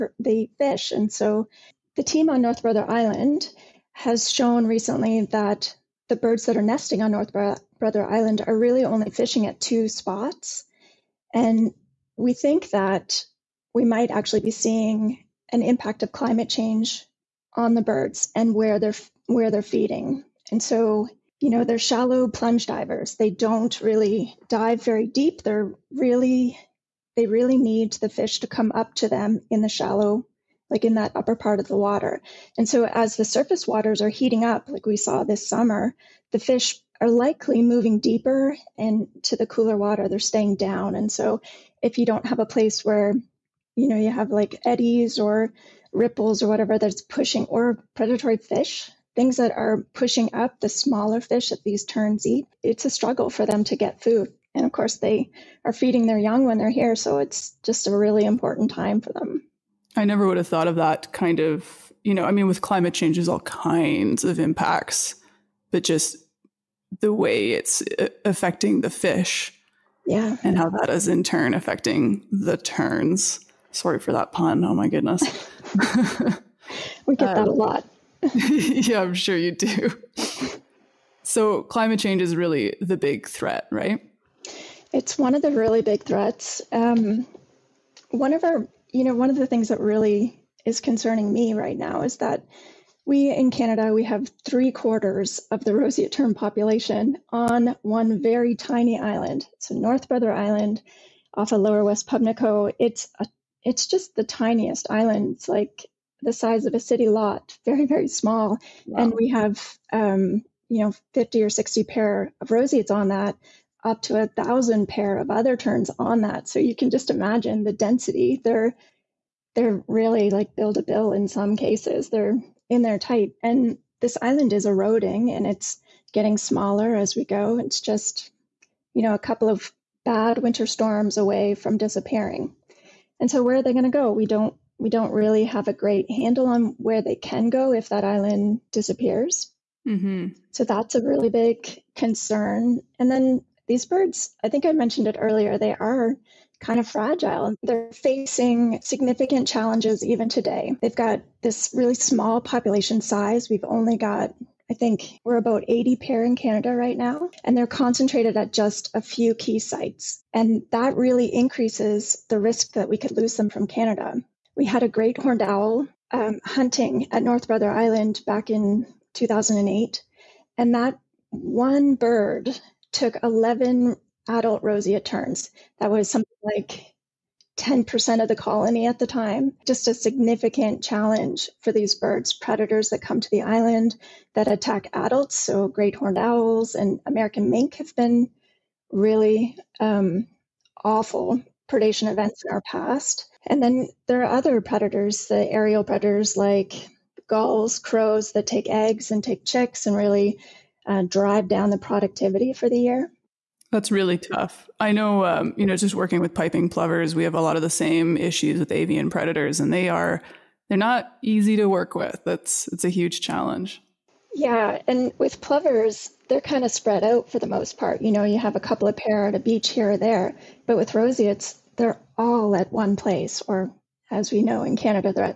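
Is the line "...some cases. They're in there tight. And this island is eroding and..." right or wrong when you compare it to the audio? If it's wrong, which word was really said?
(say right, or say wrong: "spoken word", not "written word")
right.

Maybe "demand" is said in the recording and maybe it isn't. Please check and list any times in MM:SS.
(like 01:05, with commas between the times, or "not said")
not said.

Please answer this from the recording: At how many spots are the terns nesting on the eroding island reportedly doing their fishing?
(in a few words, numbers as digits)
2.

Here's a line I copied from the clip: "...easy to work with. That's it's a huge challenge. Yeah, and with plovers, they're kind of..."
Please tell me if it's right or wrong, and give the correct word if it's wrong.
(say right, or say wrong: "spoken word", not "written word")
right.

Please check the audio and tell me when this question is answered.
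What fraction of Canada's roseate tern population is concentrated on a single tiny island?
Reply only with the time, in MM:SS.
01:34.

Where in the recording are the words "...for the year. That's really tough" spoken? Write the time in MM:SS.
03:22.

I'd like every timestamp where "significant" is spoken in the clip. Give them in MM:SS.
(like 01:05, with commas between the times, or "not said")
02:28, 02:59.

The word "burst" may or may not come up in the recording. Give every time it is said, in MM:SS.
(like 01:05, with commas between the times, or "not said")
not said.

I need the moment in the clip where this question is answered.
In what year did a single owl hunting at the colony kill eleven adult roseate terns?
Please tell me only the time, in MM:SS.
02:49.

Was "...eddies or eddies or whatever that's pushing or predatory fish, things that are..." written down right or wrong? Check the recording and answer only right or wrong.
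wrong.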